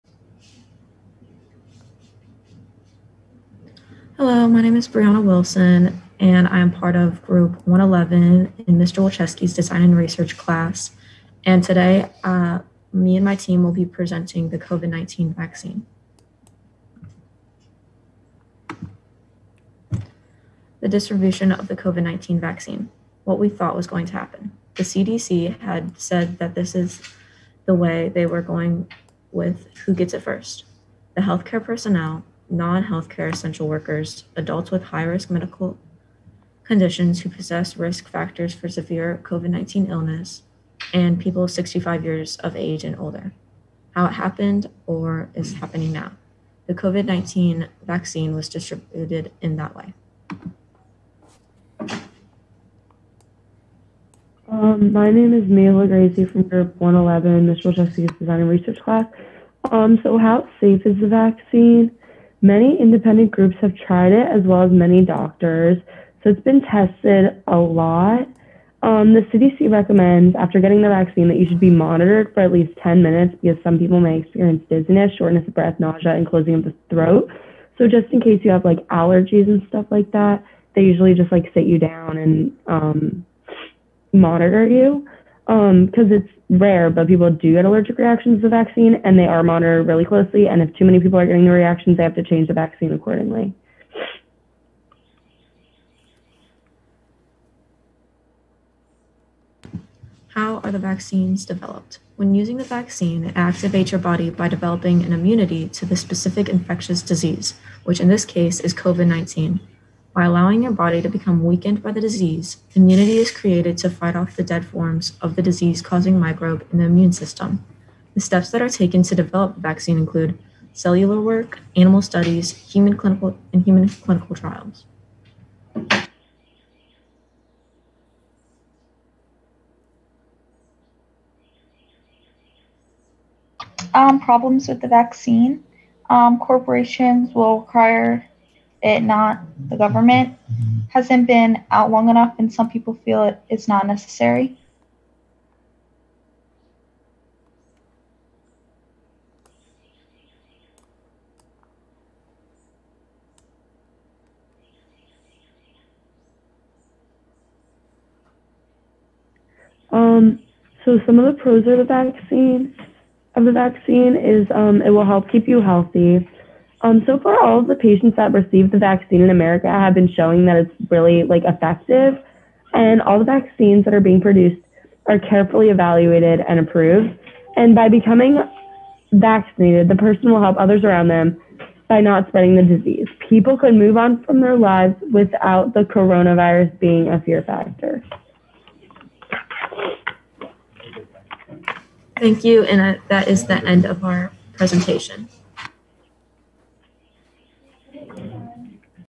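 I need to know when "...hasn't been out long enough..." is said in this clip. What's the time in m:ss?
2:20.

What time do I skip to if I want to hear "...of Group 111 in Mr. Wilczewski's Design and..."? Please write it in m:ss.
0:06.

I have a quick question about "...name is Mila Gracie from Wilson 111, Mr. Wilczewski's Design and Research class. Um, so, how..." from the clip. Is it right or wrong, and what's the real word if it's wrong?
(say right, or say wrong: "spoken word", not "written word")
wrong: "Group", not "Wilson".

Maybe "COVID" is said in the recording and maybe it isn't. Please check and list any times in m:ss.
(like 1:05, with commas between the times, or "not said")
0:14, 0:21, 0:39, 0:46, 1:48.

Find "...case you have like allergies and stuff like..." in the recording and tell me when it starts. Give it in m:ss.
1:18.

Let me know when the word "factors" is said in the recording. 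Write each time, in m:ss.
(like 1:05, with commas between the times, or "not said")
0:38, 3:07.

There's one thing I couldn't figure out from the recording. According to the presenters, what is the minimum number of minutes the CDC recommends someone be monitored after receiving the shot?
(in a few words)
10.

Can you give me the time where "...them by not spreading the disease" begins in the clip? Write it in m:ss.
3:01.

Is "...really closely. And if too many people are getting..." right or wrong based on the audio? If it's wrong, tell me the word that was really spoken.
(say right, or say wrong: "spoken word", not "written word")
right.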